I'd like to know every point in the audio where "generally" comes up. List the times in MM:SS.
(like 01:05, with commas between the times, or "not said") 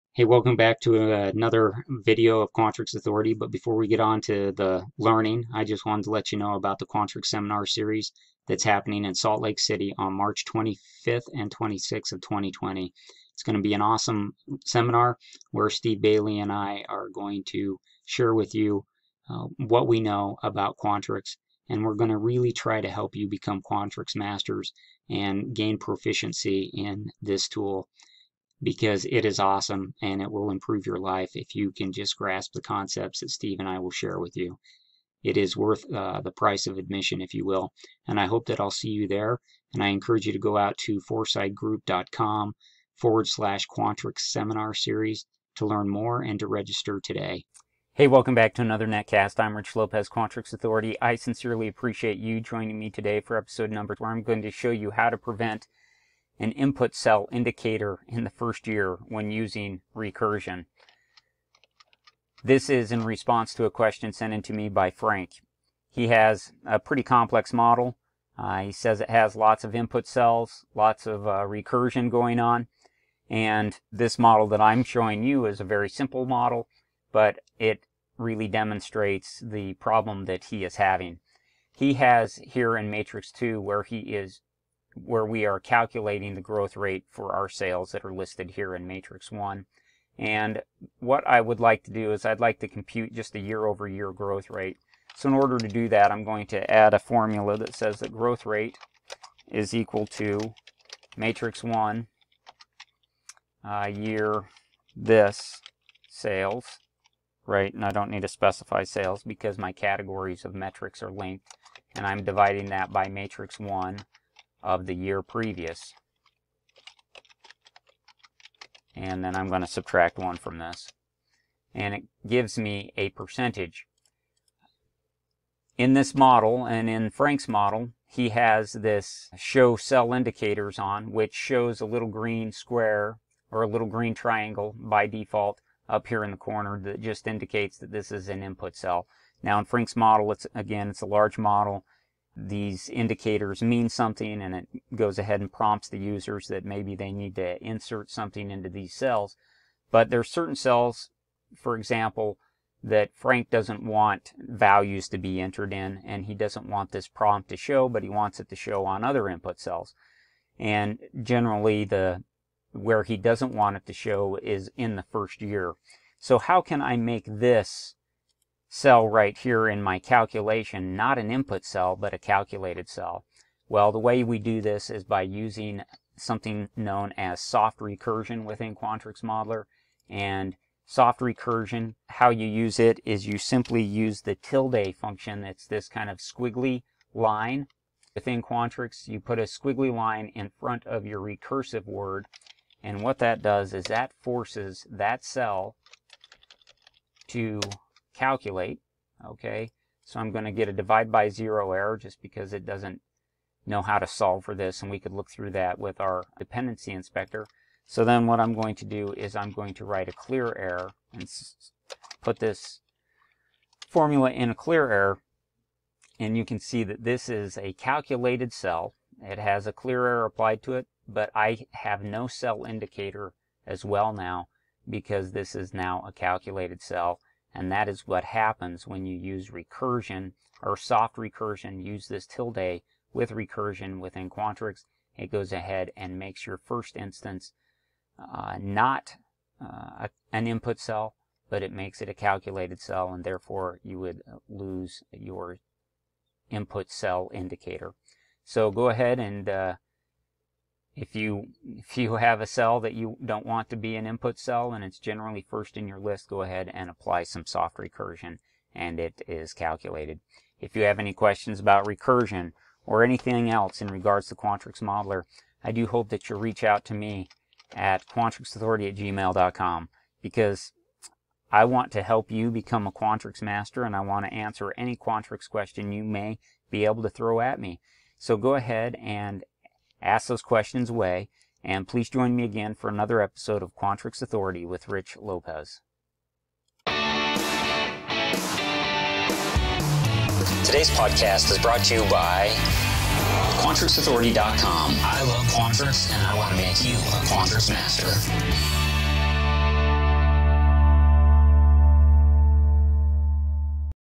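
02:41, 04:14.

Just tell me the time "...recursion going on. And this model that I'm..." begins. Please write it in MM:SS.
01:11.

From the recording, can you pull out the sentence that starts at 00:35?
It is worth uh, the price of admission, if you will.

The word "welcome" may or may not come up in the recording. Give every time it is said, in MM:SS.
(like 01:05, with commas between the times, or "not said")
00:00, 00:48.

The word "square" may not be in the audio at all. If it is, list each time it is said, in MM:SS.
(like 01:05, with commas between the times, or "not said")
02:12.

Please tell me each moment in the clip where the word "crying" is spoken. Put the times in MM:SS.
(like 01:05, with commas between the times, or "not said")
not said.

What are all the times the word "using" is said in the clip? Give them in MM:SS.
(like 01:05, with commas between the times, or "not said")
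00:59, 02:55.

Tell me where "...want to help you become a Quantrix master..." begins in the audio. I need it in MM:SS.
04:31.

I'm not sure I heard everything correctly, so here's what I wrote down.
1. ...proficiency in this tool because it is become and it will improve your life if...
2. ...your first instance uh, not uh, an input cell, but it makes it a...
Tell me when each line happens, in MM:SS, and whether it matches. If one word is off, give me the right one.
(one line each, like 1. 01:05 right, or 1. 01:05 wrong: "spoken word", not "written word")
1. 00:25 wrong: "awesome", not "become"
2. 03:56 right.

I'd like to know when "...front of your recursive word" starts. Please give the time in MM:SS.
03:10.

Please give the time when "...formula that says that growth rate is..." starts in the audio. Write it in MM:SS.
01:36.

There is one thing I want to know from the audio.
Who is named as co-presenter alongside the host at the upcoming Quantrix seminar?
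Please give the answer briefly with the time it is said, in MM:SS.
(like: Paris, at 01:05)
Steve Bailey, at 00:15.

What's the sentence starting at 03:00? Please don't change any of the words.
And soft recursion, how you use it is you simply use the tilde function.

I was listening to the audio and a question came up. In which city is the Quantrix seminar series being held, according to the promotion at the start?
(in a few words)
Salt Lake City.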